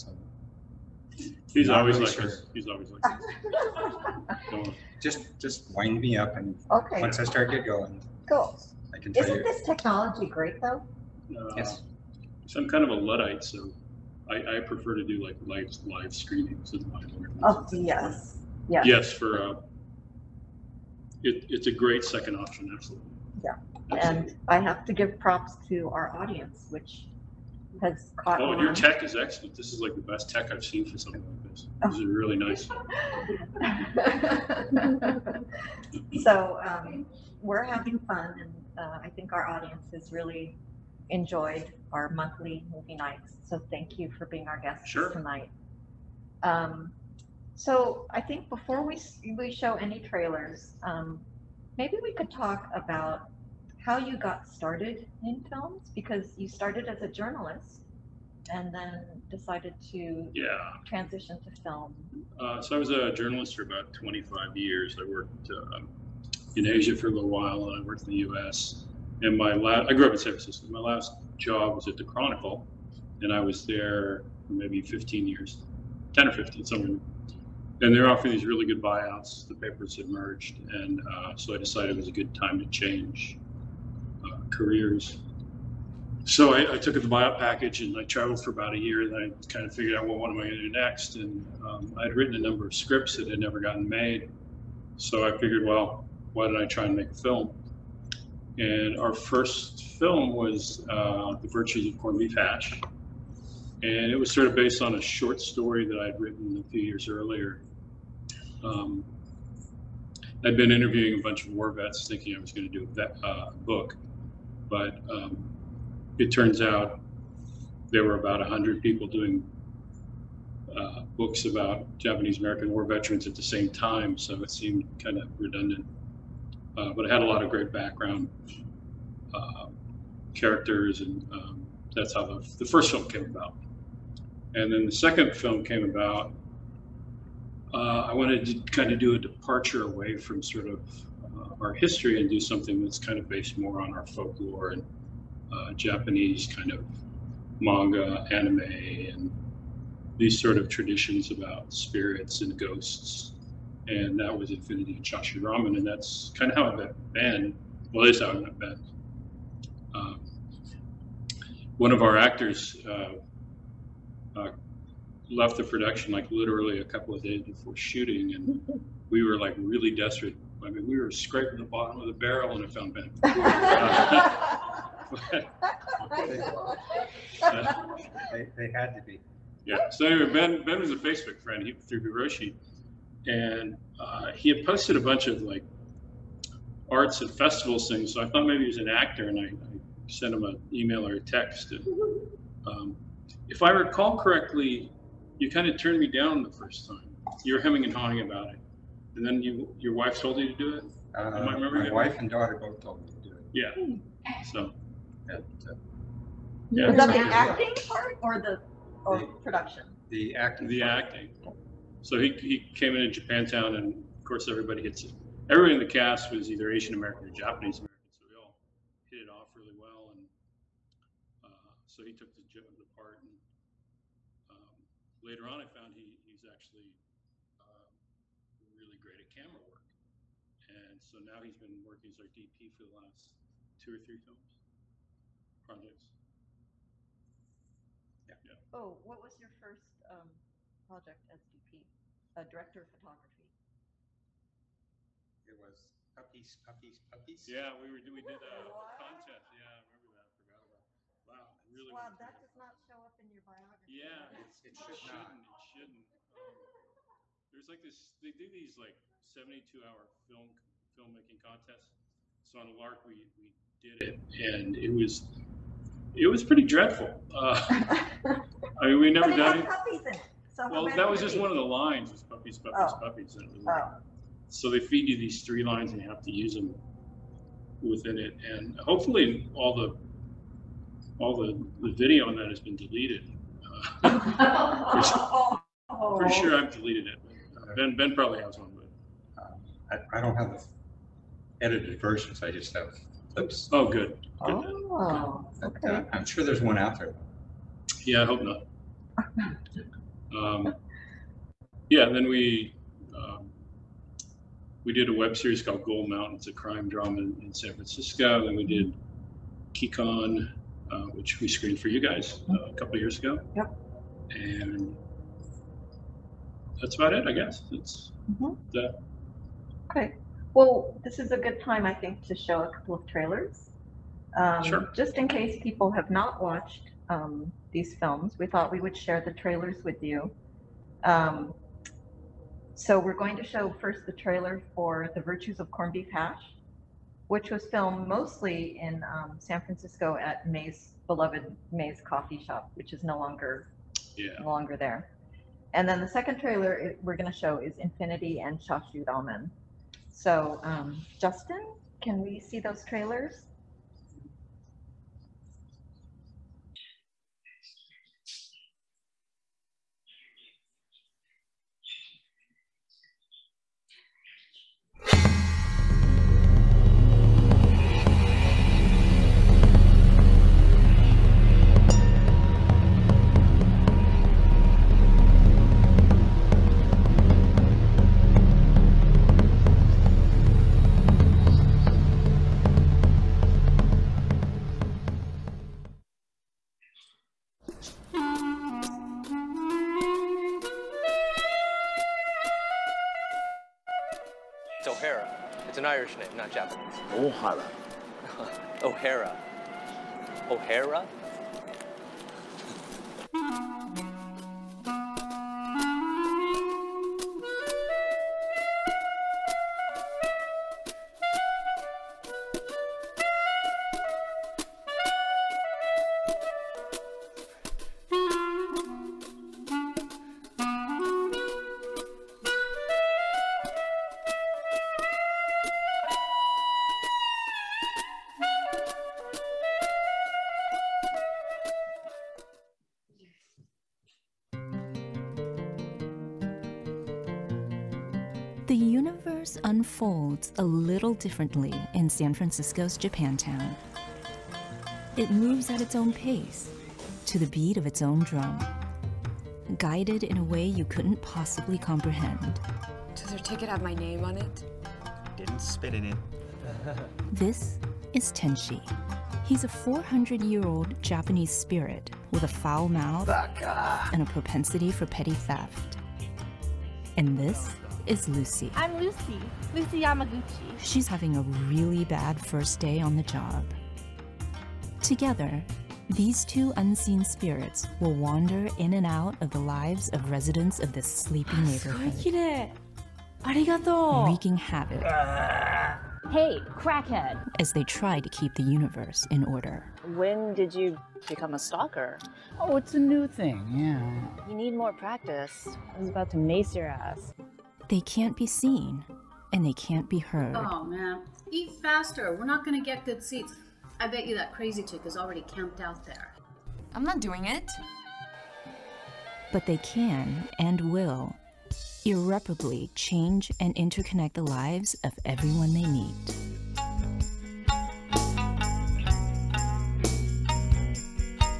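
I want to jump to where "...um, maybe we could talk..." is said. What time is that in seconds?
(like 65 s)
50 s.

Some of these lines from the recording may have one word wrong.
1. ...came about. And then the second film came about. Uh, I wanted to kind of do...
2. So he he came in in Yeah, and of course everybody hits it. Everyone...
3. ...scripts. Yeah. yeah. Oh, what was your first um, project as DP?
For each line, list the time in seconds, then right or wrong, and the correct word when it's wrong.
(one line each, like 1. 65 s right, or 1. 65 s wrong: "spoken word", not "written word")
1. 133 s right
2. 212 s wrong: "Japantown", not "Yeah"
3. 235 s wrong: "projects", not "scripts".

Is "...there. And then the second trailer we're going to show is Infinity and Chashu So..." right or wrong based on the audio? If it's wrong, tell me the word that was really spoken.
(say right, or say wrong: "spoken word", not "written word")
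right.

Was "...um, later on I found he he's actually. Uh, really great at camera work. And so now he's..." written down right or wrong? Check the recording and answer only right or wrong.
right.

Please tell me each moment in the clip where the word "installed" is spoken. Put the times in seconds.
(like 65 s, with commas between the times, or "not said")
not said.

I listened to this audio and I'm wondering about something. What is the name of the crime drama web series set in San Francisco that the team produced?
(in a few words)
Gold Mountain.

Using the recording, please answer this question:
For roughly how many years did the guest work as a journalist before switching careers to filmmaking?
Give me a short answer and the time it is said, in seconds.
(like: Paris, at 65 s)
25, at 63 s.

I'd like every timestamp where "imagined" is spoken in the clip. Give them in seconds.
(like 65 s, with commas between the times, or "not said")
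not said.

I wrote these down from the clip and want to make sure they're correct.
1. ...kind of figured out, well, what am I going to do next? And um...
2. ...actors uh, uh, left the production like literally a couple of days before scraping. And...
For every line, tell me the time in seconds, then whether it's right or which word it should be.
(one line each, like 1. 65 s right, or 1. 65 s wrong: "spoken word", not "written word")
1. 89 s right
2. 162 s wrong: "shooting", not "scraping".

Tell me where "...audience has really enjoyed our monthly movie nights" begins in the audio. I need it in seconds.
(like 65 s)
39 s.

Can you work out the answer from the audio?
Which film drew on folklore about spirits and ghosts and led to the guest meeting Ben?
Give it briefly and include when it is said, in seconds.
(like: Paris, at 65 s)
Infinity and Chashu Ramen, at 154 s.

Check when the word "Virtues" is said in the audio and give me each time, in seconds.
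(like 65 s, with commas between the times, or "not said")
101 s, 335 s.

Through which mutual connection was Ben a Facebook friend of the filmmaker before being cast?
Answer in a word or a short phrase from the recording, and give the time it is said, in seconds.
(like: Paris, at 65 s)
Hiroshi, at 182 s.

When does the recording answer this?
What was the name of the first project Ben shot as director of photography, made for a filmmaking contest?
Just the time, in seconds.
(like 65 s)
246 s.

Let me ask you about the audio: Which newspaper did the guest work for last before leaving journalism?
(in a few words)
The Chronicle.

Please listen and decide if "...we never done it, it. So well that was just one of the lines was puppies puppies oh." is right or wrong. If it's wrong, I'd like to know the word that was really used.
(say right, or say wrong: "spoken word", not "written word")
right.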